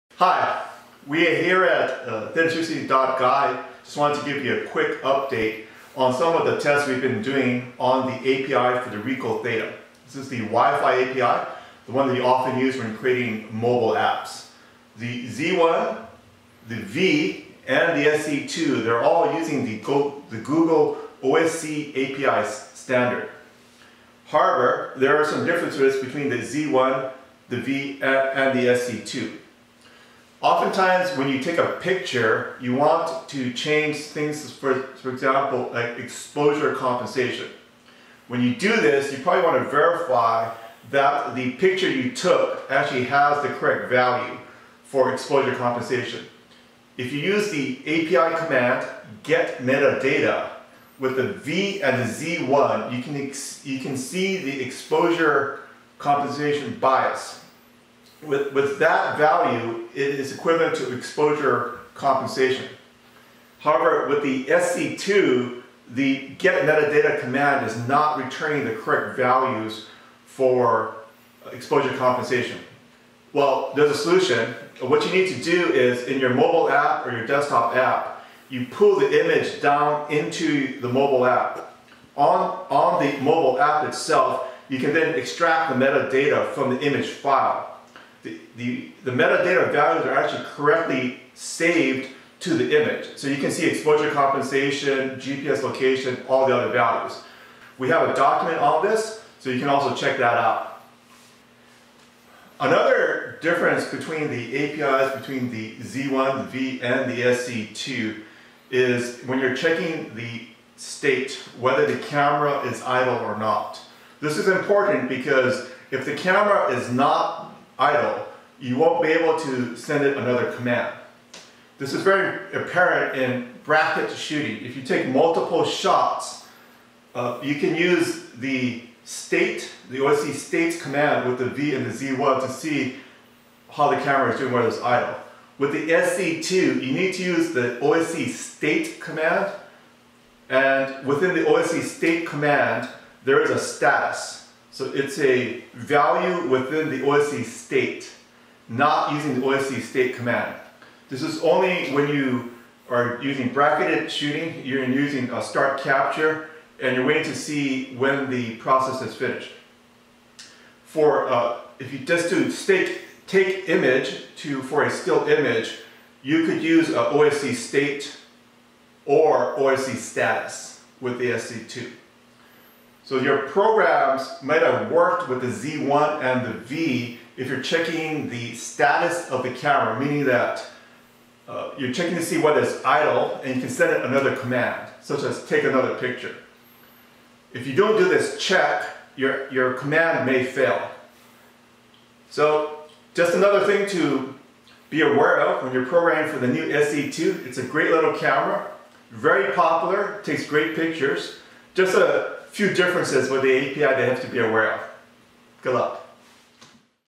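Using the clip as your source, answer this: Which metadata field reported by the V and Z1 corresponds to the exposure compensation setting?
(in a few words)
Exposure compensation bias.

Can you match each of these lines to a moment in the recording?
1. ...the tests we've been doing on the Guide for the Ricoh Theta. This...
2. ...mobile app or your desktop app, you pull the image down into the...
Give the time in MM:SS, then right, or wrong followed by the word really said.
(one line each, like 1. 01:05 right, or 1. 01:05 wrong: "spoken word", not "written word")
1. 00:06 wrong: "API", not "Guide"
2. 01:16 right.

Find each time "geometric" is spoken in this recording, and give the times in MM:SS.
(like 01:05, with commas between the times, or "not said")
not said.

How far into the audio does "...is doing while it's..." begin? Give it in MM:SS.
02:14.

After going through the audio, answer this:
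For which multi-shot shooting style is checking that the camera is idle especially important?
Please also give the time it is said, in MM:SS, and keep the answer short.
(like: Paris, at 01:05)
Bracket shooting, at 02:03.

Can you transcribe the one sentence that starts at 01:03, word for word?
However, with the SC2, the get metadata command is not returning the correct values for exposure compensation.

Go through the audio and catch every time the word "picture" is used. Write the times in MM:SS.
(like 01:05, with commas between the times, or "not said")
00:31, 00:41, 03:05, 03:20.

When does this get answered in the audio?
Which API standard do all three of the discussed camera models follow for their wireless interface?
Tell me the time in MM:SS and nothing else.
00:20.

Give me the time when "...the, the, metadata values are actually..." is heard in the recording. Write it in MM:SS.
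01:28.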